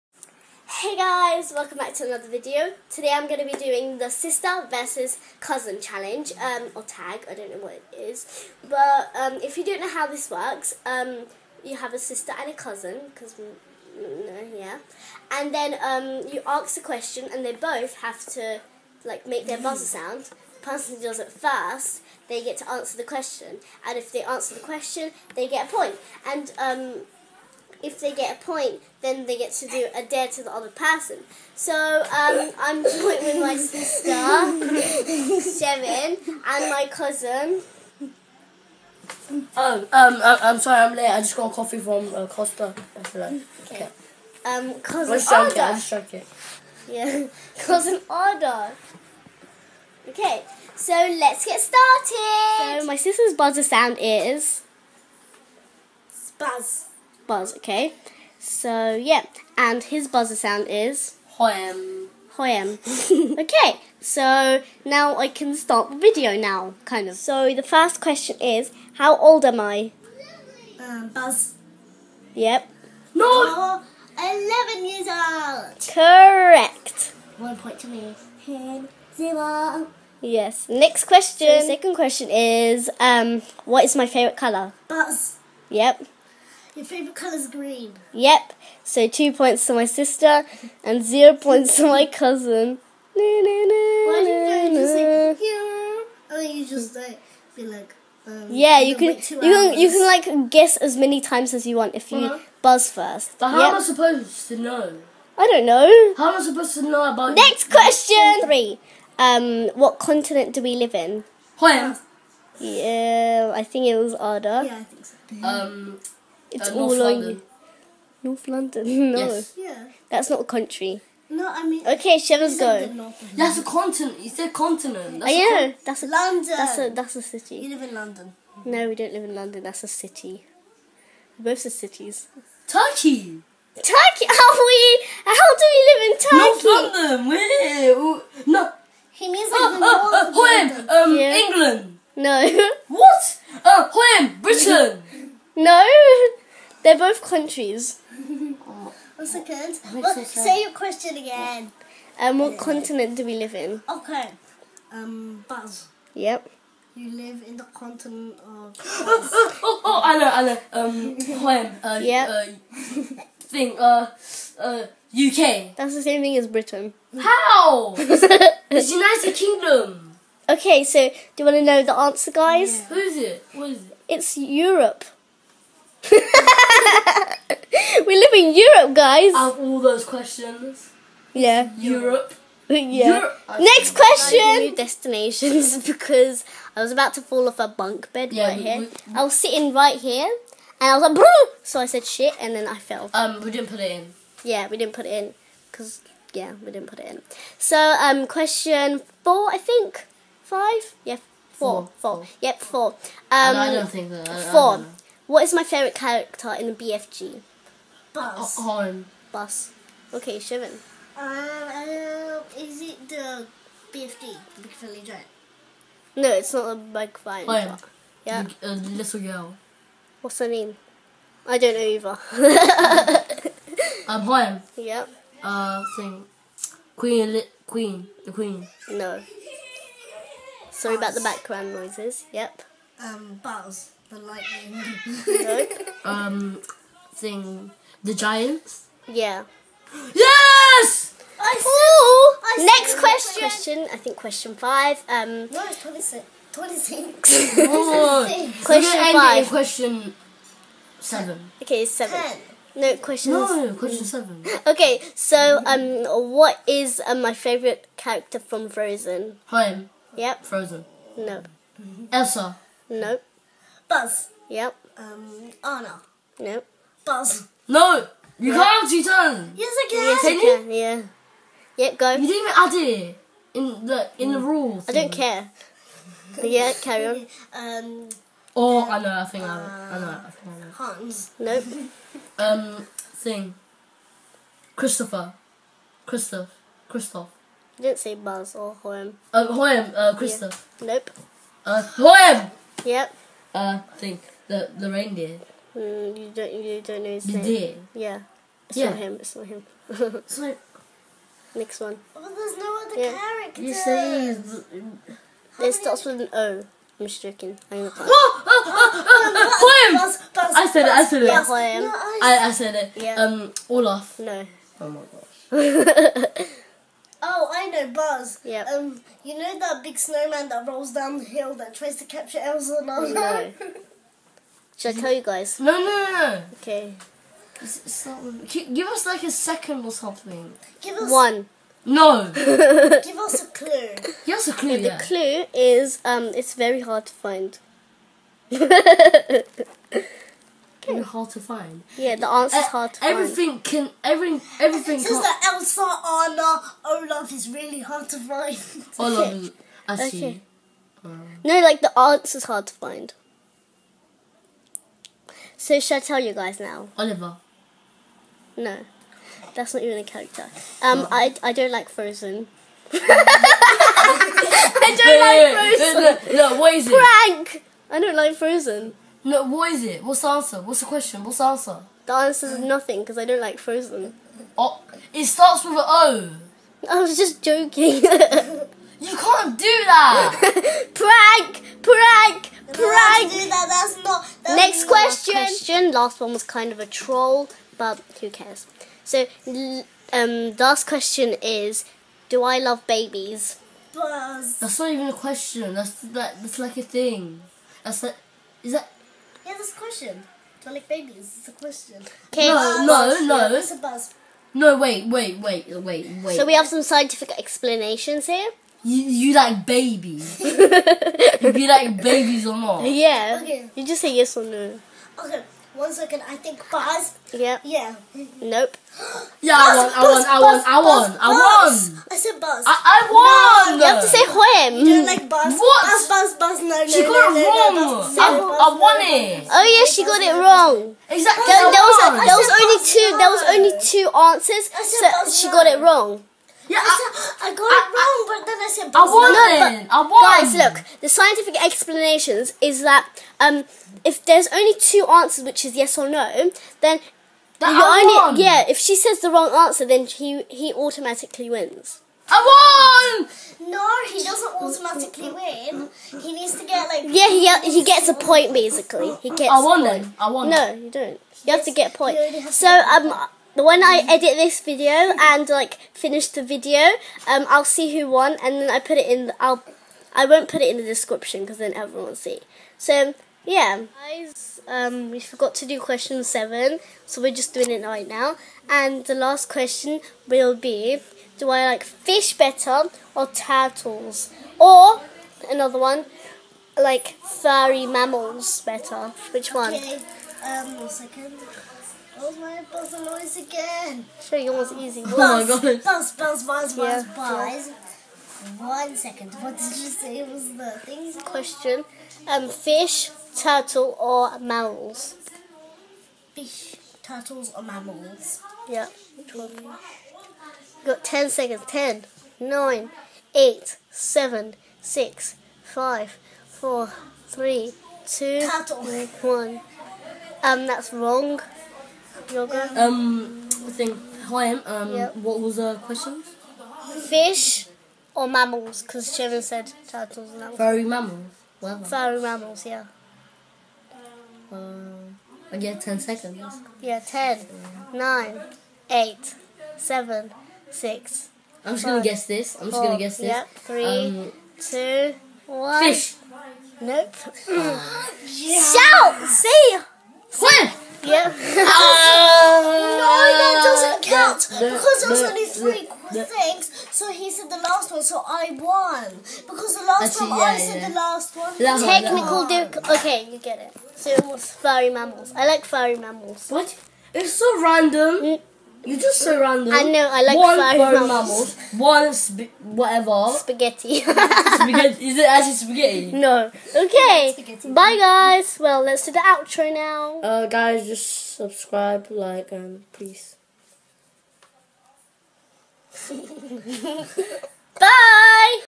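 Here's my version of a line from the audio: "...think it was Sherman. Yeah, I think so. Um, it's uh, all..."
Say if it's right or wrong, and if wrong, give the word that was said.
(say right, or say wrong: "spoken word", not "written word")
wrong: "Arda", not "Sherman".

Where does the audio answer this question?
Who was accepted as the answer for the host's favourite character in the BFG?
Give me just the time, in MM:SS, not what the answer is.
03:58.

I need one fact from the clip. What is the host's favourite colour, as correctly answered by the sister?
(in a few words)
Green.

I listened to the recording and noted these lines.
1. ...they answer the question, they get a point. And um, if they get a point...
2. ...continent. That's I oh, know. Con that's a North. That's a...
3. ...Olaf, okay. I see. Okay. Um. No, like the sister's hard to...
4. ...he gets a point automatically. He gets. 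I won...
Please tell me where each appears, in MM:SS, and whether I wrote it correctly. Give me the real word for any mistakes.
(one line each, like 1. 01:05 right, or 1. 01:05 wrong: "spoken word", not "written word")
1. 00:24 right
2. 02:04 wrong: "London", not "North"
3. 05:48 wrong: "answer", not "sister"
4. 07:37 wrong: "basically", not "automatically".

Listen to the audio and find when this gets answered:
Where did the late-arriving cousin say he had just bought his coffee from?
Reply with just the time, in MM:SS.
00:42.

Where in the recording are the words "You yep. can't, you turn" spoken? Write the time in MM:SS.
04:28.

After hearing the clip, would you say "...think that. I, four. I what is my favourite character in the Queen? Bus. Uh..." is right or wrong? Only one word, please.
wrong.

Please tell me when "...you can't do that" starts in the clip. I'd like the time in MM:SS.
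06:17.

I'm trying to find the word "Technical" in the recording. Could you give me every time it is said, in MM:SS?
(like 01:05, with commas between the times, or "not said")
09:21.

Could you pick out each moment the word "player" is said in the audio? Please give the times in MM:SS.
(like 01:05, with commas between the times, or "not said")
not said.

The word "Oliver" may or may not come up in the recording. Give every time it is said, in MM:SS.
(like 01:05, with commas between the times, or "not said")
05:56.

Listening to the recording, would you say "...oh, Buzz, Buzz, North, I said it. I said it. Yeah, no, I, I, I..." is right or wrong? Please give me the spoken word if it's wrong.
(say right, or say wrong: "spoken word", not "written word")
wrong: "Buzz", not "North".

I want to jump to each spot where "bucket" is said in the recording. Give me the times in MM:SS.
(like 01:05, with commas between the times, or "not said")
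not said.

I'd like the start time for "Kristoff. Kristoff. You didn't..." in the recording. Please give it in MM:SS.
04:46.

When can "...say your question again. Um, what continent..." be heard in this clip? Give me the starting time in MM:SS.
02:30.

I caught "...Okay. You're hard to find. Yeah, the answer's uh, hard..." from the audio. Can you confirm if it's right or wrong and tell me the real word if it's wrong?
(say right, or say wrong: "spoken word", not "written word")
right.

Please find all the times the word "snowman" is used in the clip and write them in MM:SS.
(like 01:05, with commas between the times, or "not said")
05:19.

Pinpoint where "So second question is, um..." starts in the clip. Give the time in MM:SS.
01:21.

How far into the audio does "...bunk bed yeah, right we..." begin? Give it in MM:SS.
03:07.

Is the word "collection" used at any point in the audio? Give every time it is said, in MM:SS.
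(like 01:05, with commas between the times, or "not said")
not said.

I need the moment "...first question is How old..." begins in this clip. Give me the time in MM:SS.
01:07.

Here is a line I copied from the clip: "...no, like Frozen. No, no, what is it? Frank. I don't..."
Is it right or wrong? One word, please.
right.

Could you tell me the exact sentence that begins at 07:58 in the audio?
And the last question will be: Do I like fish better or turtles, or another one?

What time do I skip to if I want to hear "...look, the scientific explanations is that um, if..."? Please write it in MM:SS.
07:20.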